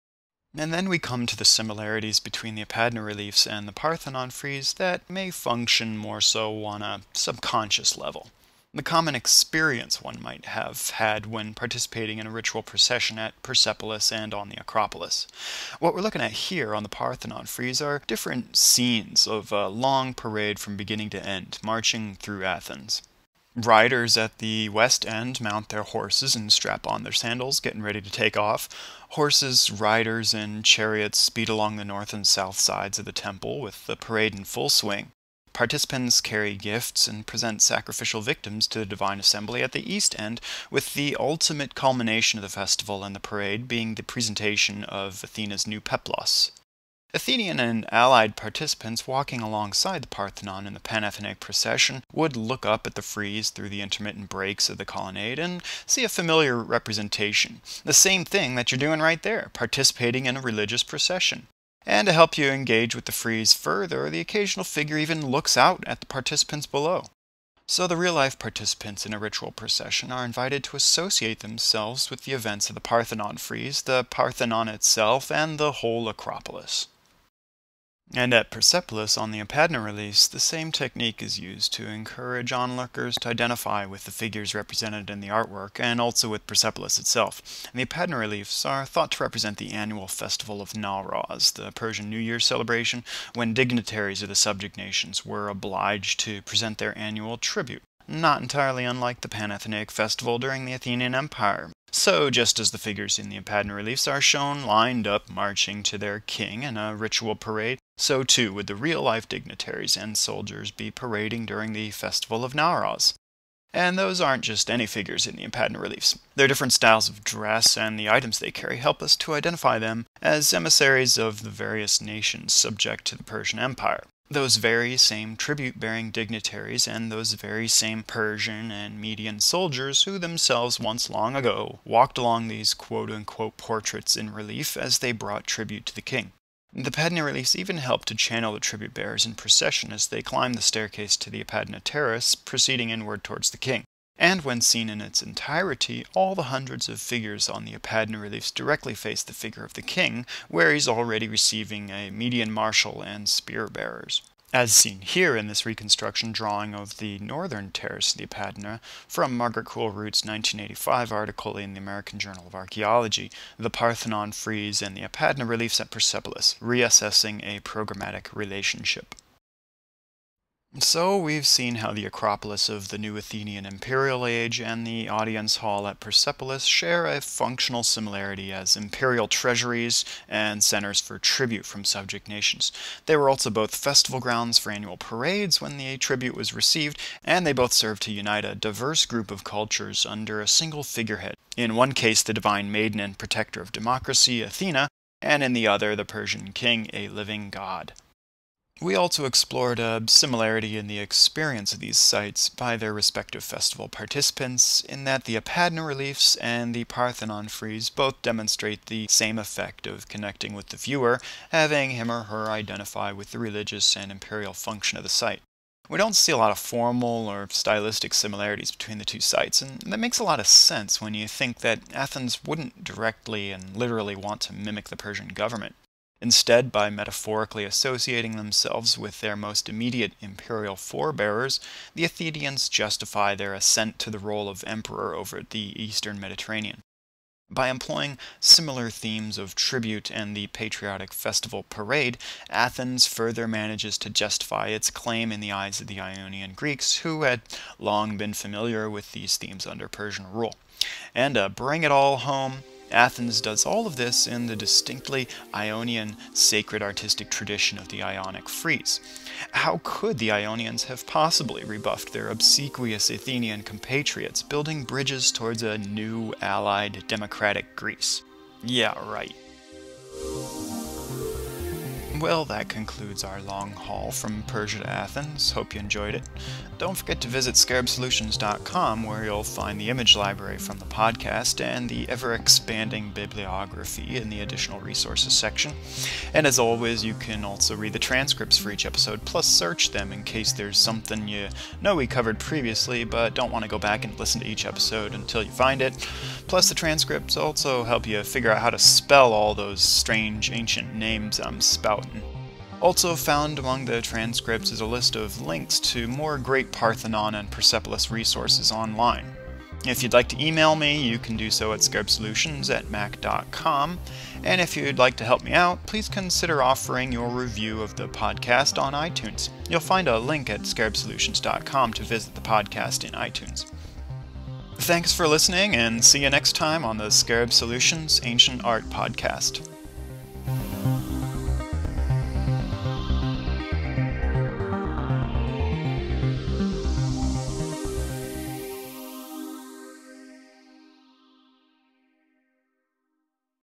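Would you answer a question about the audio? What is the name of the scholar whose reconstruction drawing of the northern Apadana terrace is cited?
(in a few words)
Margaret Cool Root.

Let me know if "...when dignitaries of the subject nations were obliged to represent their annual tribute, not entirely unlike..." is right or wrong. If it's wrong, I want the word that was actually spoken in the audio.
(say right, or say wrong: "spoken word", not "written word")
wrong: "present", not "represent".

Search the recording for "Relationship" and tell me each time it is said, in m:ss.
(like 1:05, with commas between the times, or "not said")
2:48.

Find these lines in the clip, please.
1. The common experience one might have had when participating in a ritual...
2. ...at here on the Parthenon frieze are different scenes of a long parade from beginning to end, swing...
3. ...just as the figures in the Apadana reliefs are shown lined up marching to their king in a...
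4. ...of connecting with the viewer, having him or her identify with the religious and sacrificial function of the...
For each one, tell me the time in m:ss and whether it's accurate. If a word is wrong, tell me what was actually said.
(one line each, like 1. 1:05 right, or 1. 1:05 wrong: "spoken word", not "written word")
1. 0:08 right
2. 0:16 wrong: "marching", not "swing"
3. 1:42 right
4. 3:29 wrong: "imperial", not "sacrificial".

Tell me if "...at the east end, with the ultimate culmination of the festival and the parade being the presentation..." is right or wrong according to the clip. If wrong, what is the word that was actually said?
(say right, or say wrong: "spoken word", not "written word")
right.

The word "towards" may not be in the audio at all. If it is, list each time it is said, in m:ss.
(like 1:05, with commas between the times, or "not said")
2:23, 4:25.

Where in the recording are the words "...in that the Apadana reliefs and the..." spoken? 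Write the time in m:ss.
3:24.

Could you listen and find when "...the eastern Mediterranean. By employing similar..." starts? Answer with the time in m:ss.
3:55.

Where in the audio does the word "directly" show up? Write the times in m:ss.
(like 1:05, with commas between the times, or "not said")
2:28, 3:42.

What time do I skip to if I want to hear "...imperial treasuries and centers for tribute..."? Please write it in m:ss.
2:58.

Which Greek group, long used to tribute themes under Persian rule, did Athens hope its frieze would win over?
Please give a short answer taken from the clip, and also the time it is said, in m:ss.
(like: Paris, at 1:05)
Ionian Greeks, at 4:05.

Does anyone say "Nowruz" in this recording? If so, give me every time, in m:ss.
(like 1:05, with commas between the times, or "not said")
1:30, 1:52.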